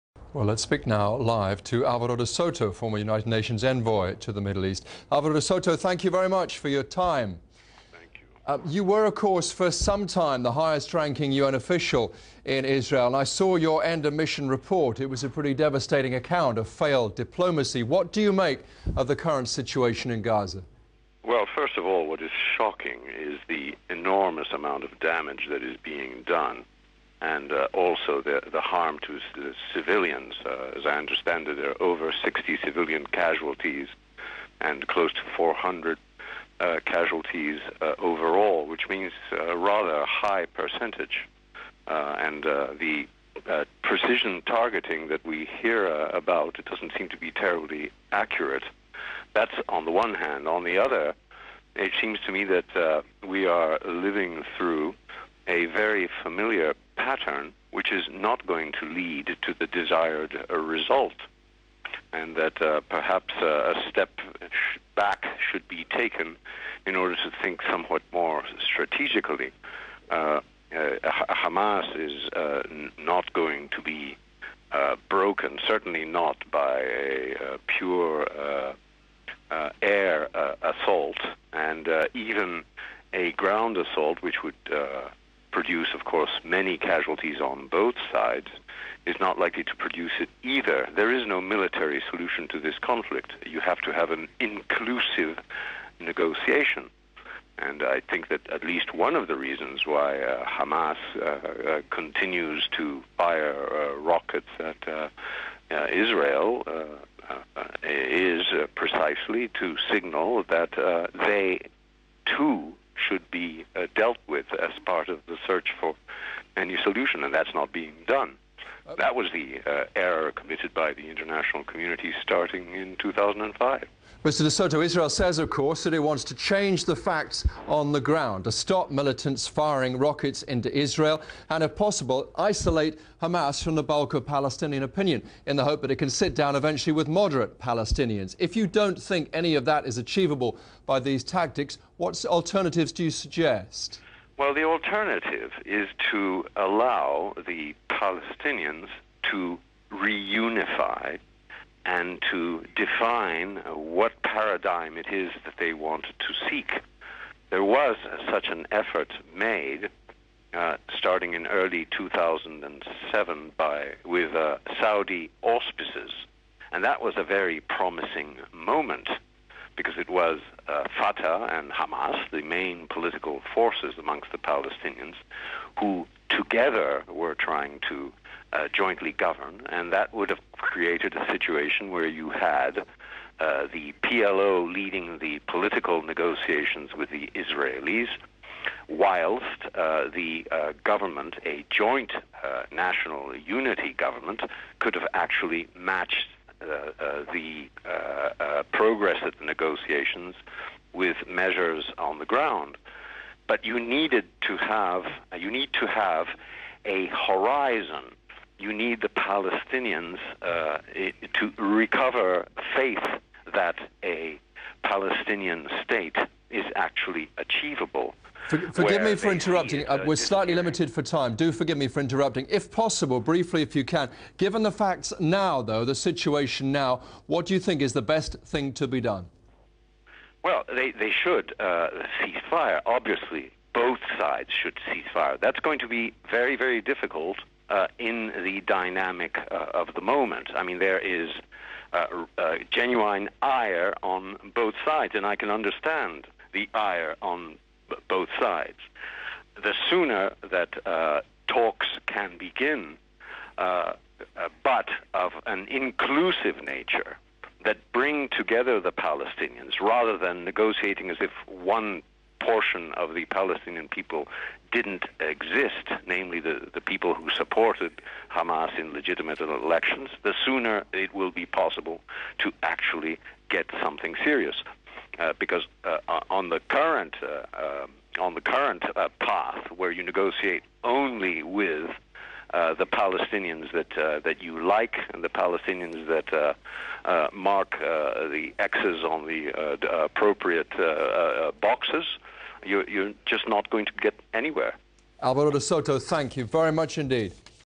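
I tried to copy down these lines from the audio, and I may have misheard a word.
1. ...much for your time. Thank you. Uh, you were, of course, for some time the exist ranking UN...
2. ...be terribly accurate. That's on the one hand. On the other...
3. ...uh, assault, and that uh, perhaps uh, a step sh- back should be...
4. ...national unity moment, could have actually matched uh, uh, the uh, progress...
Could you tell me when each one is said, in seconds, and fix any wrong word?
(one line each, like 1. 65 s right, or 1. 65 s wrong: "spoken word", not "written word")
1. 6 s wrong: "highest", not "exist"
2. 47 s right
3. 60 s wrong: "result", not "assault"
4. 192 s wrong: "government", not "moment".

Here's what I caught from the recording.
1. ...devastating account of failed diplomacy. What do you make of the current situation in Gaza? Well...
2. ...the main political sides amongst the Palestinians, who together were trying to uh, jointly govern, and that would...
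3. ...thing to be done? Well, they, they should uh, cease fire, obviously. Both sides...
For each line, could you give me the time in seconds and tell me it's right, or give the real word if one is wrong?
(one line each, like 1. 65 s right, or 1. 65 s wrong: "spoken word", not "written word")
1. 15 s right
2. 172 s wrong: "forces", not "sides"
3. 228 s right.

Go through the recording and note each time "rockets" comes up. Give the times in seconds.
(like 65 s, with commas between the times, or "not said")
103 s, 129 s.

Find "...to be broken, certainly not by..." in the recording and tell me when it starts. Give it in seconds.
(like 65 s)
73 s.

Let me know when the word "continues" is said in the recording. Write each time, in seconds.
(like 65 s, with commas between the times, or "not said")
101 s.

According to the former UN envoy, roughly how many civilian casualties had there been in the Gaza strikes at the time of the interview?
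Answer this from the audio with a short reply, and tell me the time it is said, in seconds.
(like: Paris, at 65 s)
over 60, at 31 s.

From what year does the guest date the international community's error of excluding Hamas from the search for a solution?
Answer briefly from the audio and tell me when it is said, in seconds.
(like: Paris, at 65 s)
2005, at 122 s.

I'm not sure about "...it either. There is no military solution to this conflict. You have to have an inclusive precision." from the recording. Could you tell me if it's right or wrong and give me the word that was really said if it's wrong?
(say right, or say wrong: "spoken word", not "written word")
wrong: "negotiation", not "precision".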